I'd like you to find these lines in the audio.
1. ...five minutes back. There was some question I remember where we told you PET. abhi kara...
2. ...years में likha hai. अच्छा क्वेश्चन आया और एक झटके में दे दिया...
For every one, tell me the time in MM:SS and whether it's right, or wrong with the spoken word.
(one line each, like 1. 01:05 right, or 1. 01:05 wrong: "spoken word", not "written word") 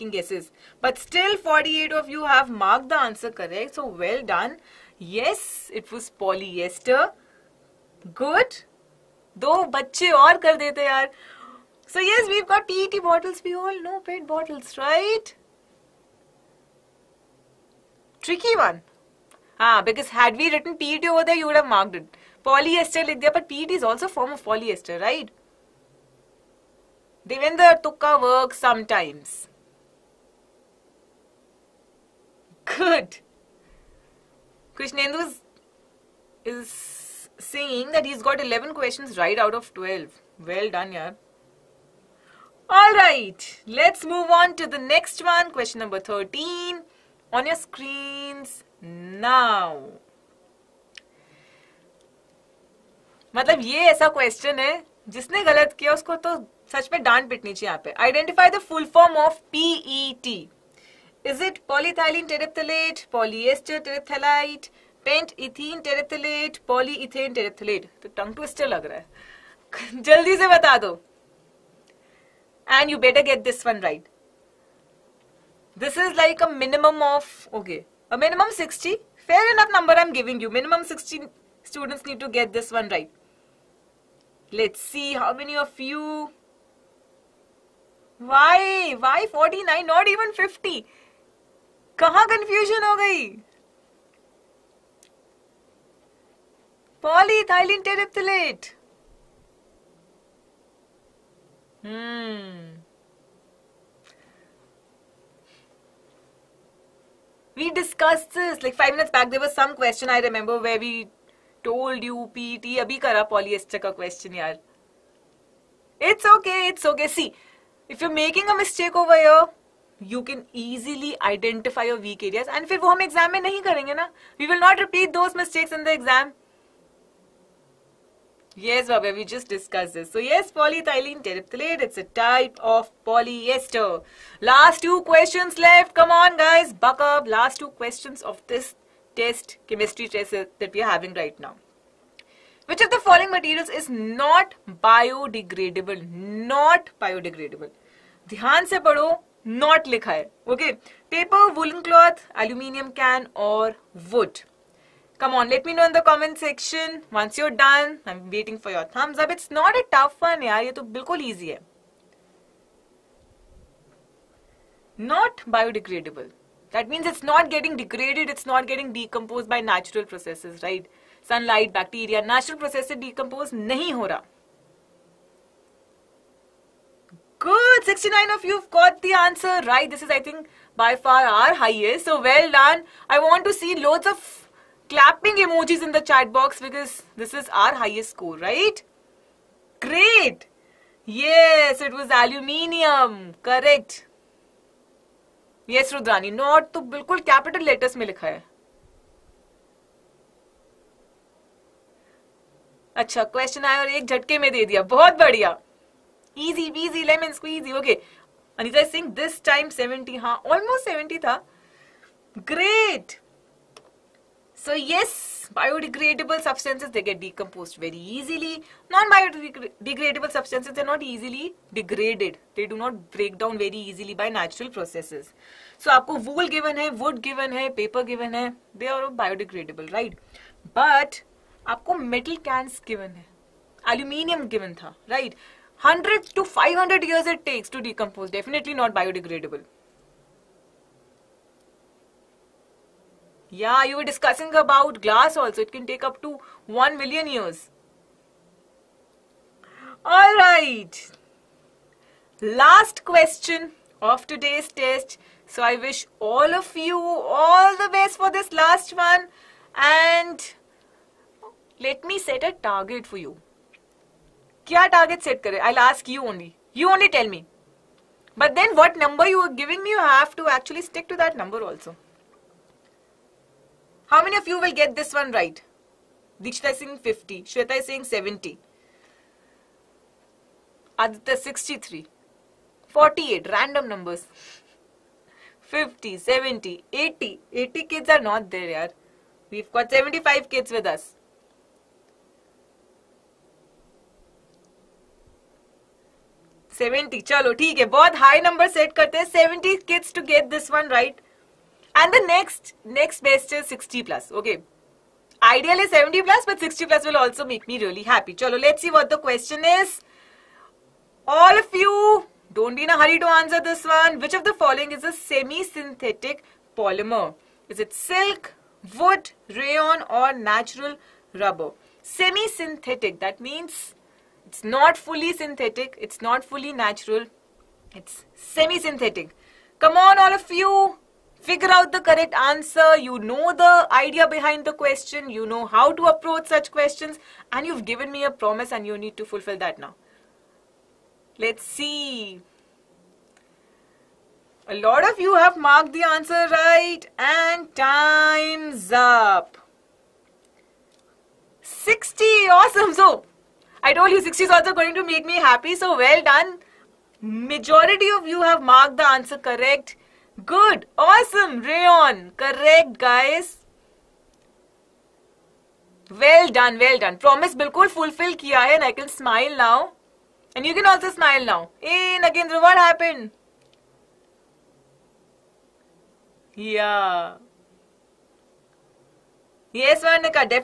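1. 01:48 right
2. 03:17 wrong: "letters", not "years".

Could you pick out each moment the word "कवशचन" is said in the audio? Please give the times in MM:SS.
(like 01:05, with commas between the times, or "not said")
00:54, 03:23.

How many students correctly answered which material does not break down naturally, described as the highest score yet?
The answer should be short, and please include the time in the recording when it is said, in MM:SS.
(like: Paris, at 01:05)
69, at 02:57.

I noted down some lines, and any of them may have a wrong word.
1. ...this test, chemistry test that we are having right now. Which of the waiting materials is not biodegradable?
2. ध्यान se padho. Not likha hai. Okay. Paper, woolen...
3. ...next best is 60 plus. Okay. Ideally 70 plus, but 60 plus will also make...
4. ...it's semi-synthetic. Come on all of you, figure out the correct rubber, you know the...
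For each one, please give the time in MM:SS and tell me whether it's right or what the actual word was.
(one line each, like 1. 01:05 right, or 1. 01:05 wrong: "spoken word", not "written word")
1. 02:18 wrong: "following", not "waiting"
2. 02:28 right
3. 05:02 right
4. 05:27 wrong: "answer", not "rubber".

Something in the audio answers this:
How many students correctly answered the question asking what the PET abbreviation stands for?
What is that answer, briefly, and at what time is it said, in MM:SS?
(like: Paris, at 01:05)
49, at 01:29.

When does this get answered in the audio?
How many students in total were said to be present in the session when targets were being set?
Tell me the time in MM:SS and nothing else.
04:49.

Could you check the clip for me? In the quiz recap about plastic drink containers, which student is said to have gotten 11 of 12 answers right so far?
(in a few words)
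Krishnendu.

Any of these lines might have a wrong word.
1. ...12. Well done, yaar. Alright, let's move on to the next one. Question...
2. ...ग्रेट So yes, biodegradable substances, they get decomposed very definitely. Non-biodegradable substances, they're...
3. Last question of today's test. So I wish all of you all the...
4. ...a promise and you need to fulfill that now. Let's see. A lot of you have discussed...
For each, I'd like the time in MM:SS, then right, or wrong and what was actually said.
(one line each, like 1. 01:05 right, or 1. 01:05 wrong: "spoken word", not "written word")
1. 00:39 right
2. 03:32 wrong: "easily", not "definitely"
3. 04:12 right
4. 05:38 wrong: "marked", not "discussed".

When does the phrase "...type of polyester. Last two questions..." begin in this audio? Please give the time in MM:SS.
02:12.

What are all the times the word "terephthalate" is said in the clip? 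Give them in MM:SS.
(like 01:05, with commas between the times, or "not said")
01:37, 02:11.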